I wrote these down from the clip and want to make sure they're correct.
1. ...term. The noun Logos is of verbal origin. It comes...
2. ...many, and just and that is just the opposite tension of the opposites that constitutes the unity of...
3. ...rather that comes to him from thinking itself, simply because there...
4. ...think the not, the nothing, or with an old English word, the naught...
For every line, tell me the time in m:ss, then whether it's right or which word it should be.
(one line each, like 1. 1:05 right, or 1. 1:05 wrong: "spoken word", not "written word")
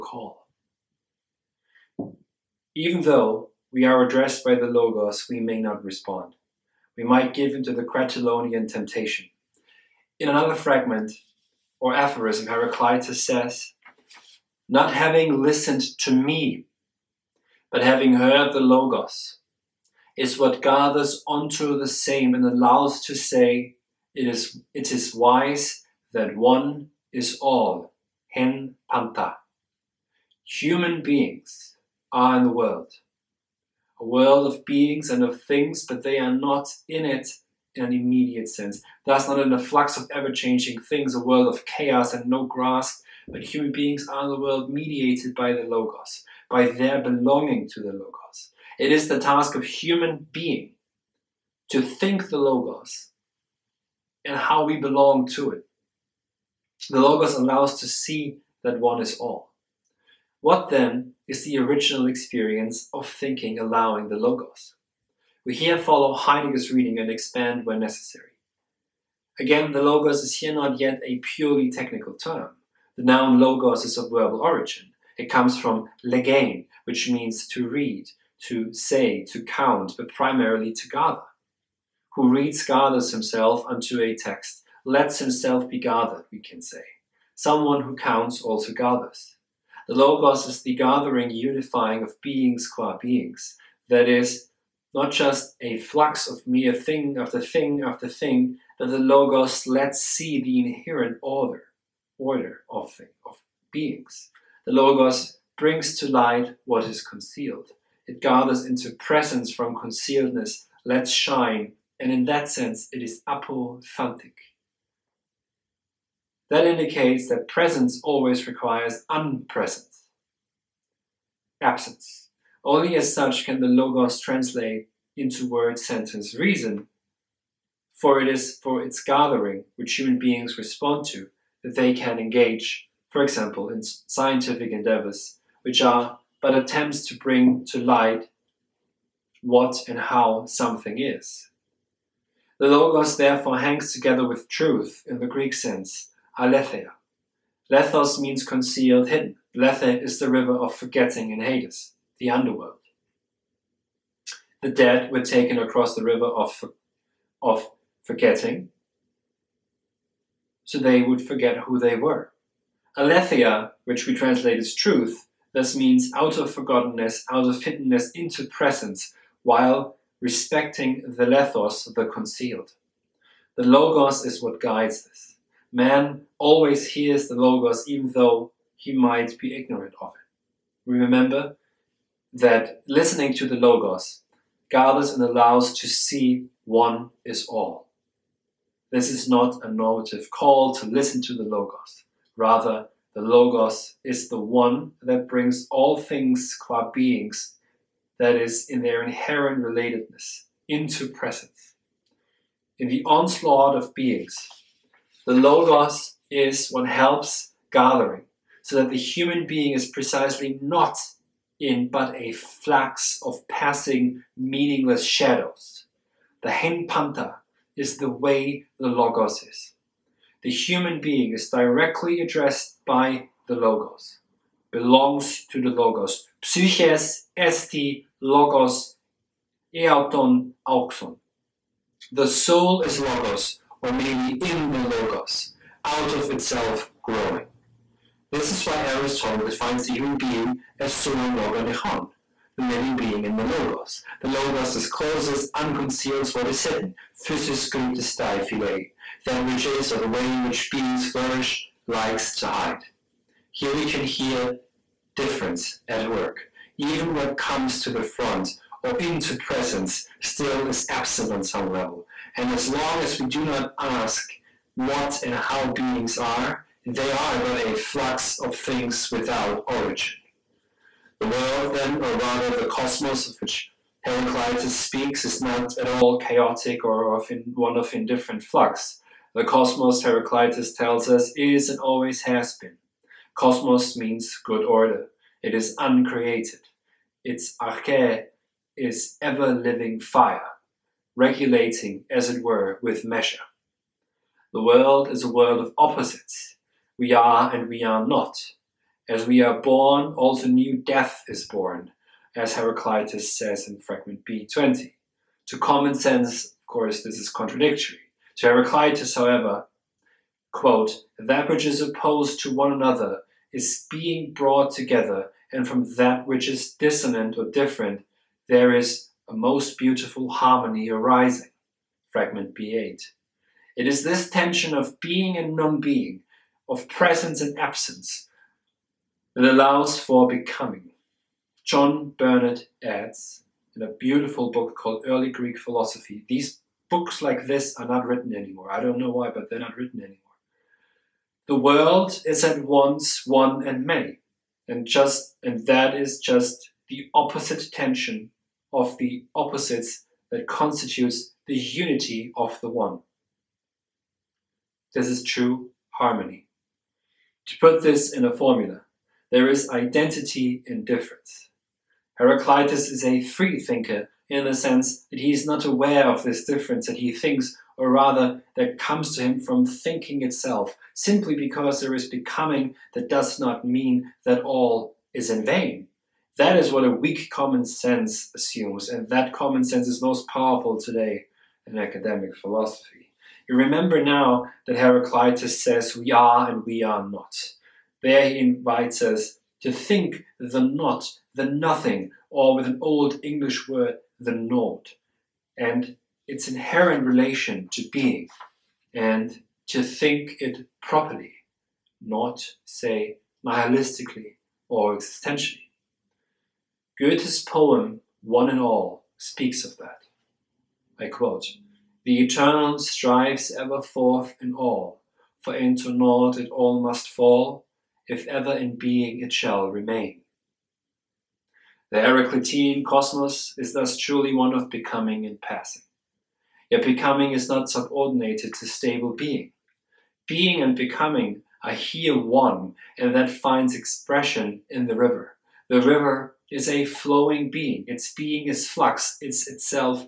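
1. 1:12 right
2. 5:43 right
3. 6:07 right
4. 6:29 right.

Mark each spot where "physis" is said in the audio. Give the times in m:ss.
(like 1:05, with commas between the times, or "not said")
4:07.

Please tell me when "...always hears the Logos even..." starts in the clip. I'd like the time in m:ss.
2:56.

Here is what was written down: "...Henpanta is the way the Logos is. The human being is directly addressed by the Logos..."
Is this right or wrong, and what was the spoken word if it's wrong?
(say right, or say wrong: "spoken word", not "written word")
right.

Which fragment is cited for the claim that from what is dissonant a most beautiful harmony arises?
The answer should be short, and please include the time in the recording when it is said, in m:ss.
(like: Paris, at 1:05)
B8, at 5:22.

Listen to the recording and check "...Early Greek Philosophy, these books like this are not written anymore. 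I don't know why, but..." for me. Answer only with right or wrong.
right.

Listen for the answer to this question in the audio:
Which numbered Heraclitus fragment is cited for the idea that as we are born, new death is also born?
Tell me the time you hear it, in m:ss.
5:03.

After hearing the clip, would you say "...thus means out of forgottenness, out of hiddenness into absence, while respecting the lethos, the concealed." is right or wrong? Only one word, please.
wrong.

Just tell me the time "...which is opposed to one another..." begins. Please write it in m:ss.
5:11.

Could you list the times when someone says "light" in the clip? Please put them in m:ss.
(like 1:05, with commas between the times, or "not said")
1:46, 2:17.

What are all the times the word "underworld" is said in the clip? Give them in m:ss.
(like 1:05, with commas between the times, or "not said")
2:32.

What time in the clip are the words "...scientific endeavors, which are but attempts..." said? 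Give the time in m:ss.
2:13.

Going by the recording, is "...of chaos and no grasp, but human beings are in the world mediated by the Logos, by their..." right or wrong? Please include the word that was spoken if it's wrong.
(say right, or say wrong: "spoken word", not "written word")
right.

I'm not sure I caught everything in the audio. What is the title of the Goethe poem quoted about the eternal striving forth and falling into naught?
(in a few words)
One and All.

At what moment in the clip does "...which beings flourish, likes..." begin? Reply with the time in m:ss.
4:10.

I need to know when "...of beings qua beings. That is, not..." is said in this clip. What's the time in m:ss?
1:32.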